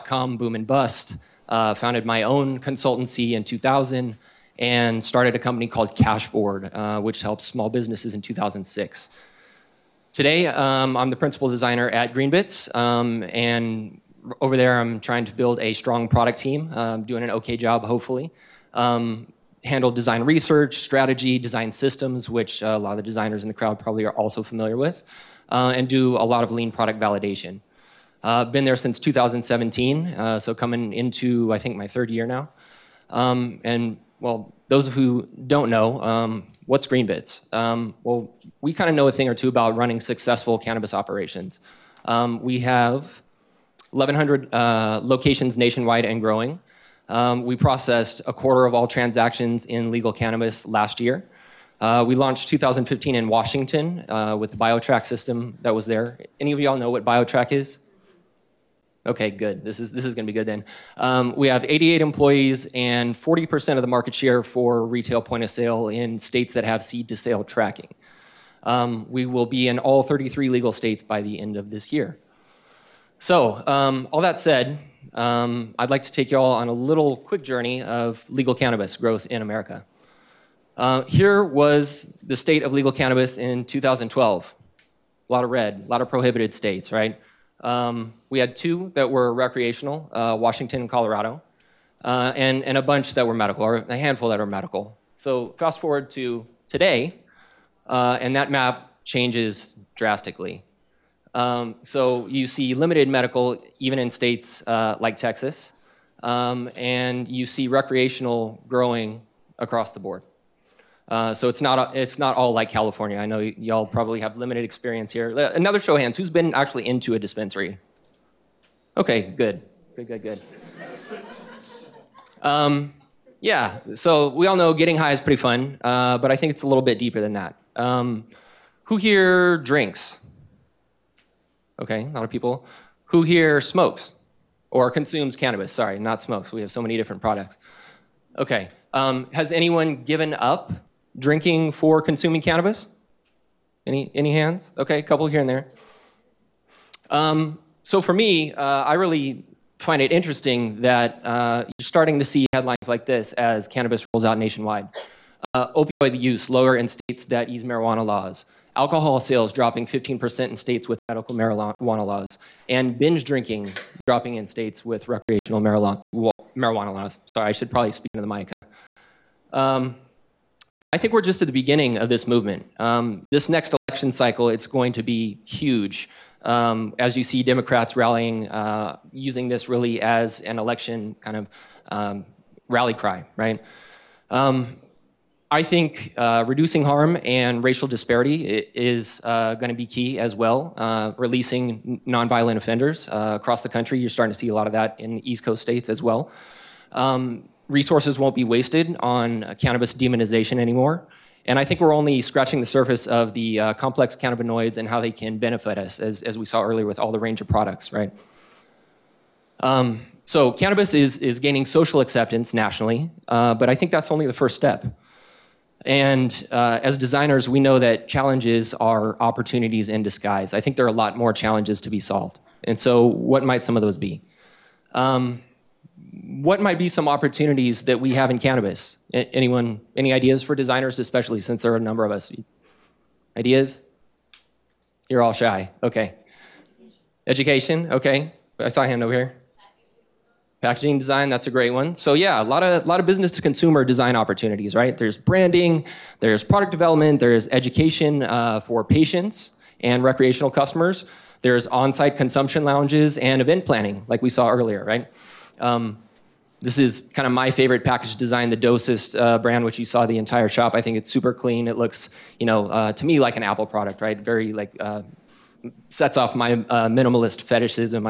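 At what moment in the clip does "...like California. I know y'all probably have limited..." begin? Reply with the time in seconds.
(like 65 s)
112 s.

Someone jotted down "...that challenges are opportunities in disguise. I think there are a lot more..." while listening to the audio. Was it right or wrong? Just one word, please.
right.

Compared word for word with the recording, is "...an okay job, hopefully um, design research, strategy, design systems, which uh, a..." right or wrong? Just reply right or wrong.
right.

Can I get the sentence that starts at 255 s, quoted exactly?
Um, this is kind of my favorite package design, the Dosist uh, brand, which you saw the entire shop.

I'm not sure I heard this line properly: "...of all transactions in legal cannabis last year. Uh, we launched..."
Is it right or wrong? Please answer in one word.
right.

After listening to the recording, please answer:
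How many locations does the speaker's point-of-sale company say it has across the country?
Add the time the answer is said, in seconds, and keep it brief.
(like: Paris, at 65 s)
1,100, at 43 s.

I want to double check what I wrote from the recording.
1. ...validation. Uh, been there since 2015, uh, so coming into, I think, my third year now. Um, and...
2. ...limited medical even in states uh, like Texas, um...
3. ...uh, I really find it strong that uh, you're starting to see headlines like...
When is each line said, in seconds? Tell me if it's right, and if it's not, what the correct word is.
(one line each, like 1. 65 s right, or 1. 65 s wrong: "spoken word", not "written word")
1. 26 s wrong: "2017", not "2015"
2. 102 s right
3. 148 s wrong: "interesting", not "strong".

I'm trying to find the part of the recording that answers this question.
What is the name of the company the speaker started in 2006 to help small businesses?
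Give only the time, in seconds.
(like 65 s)
5 s.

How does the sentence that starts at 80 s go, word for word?
Uh, here was the state of legal cannabis in 2012.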